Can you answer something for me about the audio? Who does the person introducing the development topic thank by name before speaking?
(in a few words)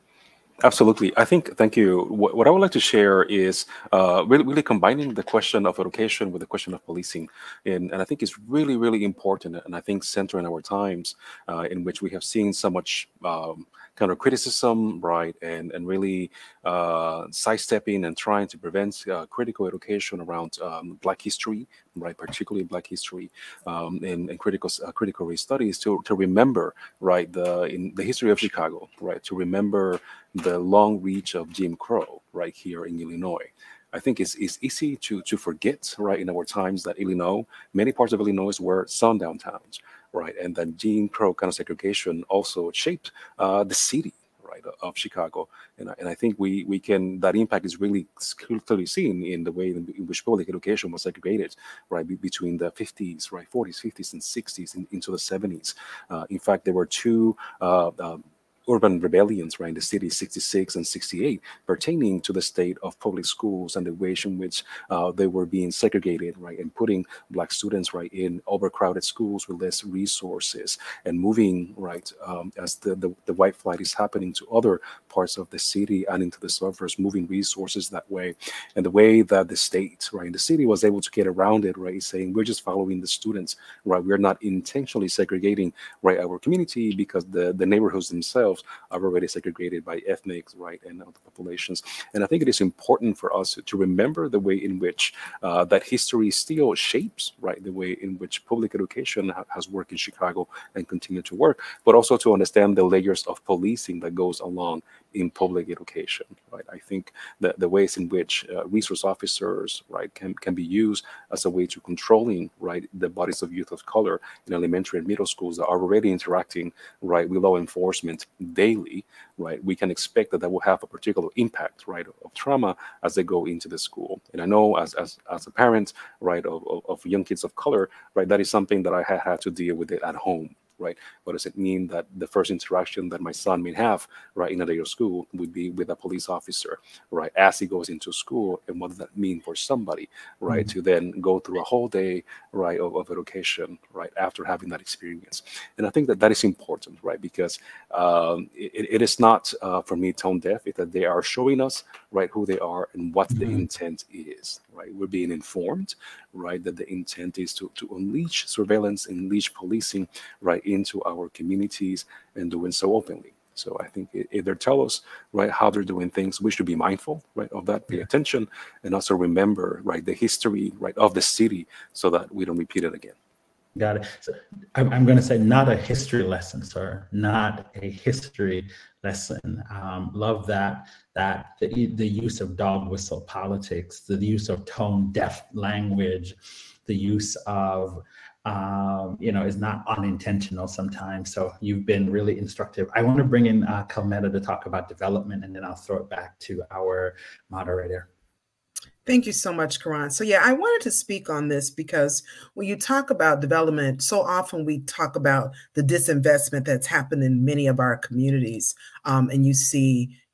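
Karan.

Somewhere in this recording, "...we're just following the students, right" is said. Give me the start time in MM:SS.
01:22.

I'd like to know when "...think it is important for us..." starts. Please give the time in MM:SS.
01:32.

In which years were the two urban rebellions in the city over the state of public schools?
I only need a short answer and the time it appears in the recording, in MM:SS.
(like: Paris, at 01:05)
66 and 68, at 01:00.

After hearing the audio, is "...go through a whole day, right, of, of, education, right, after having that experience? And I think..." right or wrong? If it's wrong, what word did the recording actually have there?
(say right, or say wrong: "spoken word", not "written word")
right.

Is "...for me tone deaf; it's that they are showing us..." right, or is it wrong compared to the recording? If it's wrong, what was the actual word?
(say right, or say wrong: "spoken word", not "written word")
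right.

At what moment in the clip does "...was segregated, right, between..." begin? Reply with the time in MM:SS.
00:50.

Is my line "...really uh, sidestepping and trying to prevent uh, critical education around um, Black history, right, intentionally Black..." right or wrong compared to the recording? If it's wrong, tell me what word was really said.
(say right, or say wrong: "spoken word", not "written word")
wrong: "particularly", not "intentionally".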